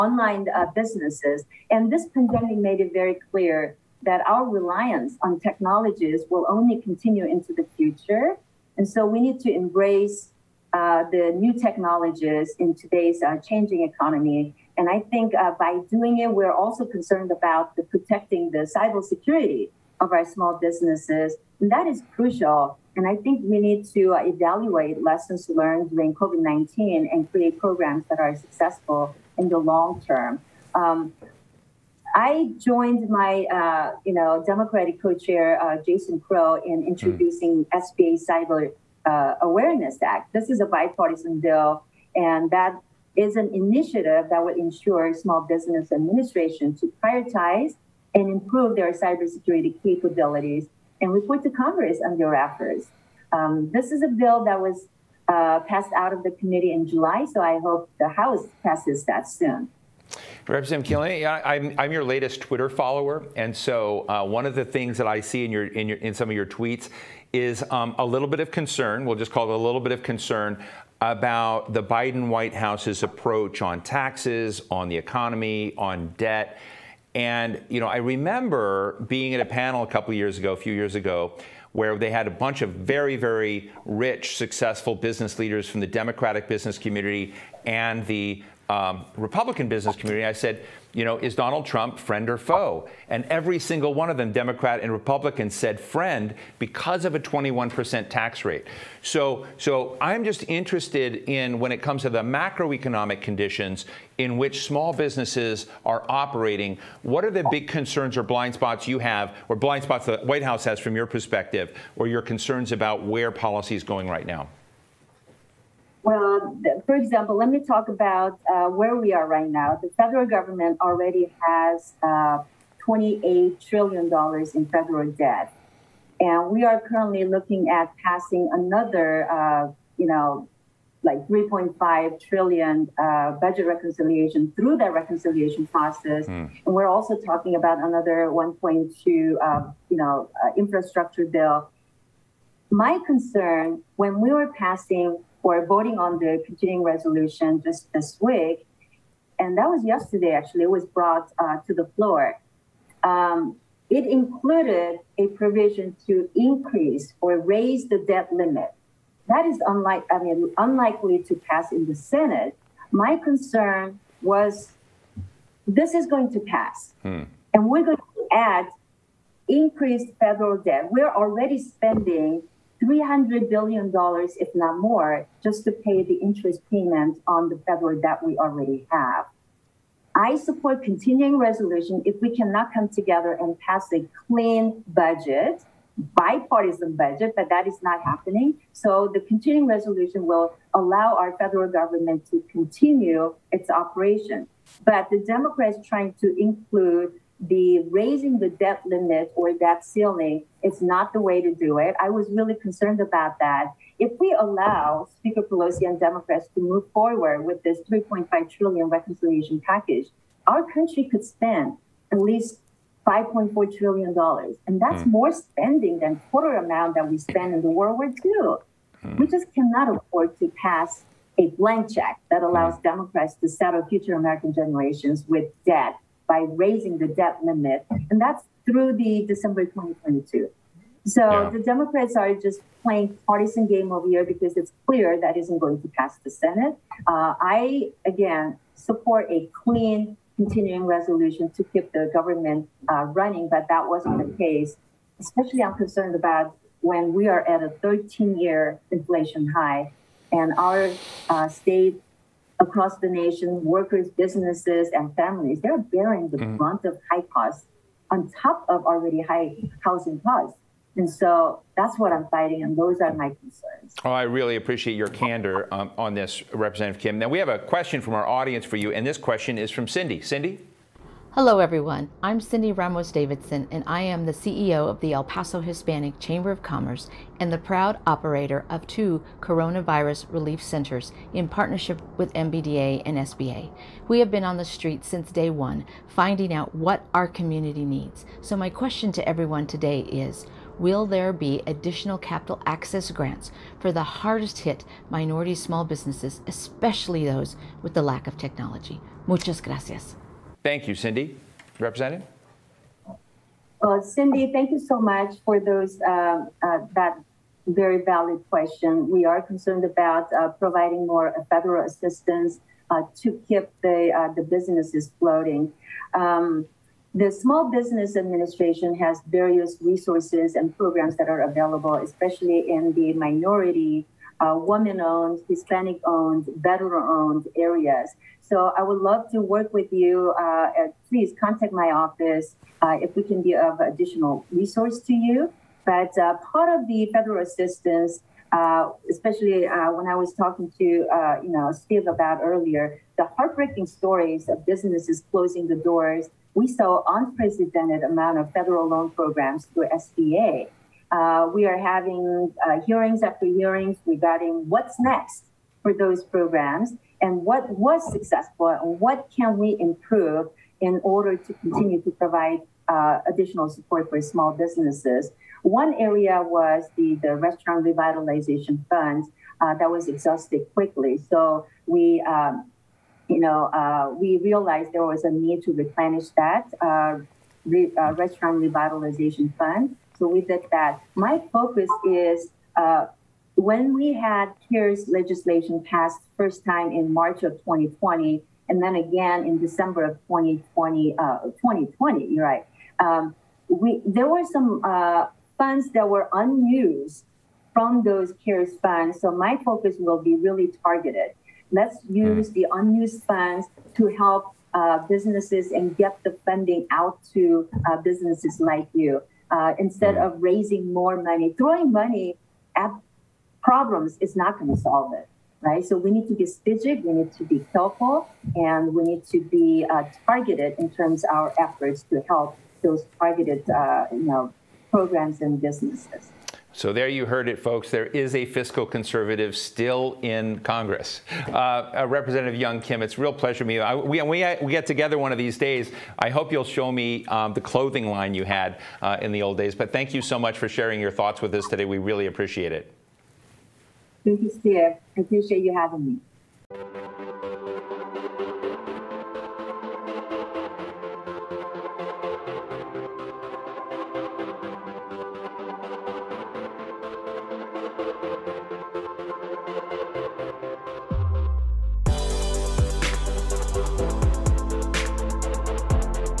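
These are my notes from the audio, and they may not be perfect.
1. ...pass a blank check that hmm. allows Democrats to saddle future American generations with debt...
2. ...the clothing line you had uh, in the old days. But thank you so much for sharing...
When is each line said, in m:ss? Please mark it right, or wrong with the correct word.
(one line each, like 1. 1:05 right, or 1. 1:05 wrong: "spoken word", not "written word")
1. 3:40 right
2. 7:17 right.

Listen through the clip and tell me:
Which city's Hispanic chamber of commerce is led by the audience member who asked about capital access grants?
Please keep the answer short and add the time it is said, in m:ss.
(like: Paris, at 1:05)
El Paso, at 4:35.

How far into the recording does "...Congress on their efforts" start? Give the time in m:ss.
0:51.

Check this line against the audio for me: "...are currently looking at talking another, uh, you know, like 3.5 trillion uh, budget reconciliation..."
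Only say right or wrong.
wrong.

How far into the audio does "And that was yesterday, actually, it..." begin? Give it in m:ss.
2:29.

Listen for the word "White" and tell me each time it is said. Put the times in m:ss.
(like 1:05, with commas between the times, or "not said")
1:12, 1:50.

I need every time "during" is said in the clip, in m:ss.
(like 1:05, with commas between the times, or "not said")
0:25.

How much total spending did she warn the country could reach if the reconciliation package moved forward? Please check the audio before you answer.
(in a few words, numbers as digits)
5.4 trillion dollars.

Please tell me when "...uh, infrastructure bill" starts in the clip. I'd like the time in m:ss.
2:20.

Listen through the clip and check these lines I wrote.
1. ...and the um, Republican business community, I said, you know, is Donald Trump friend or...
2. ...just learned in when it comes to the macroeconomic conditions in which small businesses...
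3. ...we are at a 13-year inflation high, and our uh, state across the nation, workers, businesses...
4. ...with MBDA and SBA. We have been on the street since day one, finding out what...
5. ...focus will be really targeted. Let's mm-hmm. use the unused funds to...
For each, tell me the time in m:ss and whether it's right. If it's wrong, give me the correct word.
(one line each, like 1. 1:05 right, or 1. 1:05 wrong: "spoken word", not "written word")
1. 1:27 right
2. 1:40 wrong: "interested", not "learned"
3. 4:07 right
4. 4:42 right
5. 6:39 right.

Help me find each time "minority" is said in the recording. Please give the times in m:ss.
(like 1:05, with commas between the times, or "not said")
4:55, 5:23.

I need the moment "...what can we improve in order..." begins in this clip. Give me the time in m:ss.
5:58.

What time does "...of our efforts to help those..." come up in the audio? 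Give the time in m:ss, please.
7:01.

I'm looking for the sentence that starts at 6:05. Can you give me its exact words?
One area was the, the restaurant revitalization fund uh, that was exhausted quickly.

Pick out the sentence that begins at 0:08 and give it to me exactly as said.
And so we need to embrace uh, the new technologies in today's uh, changing economy.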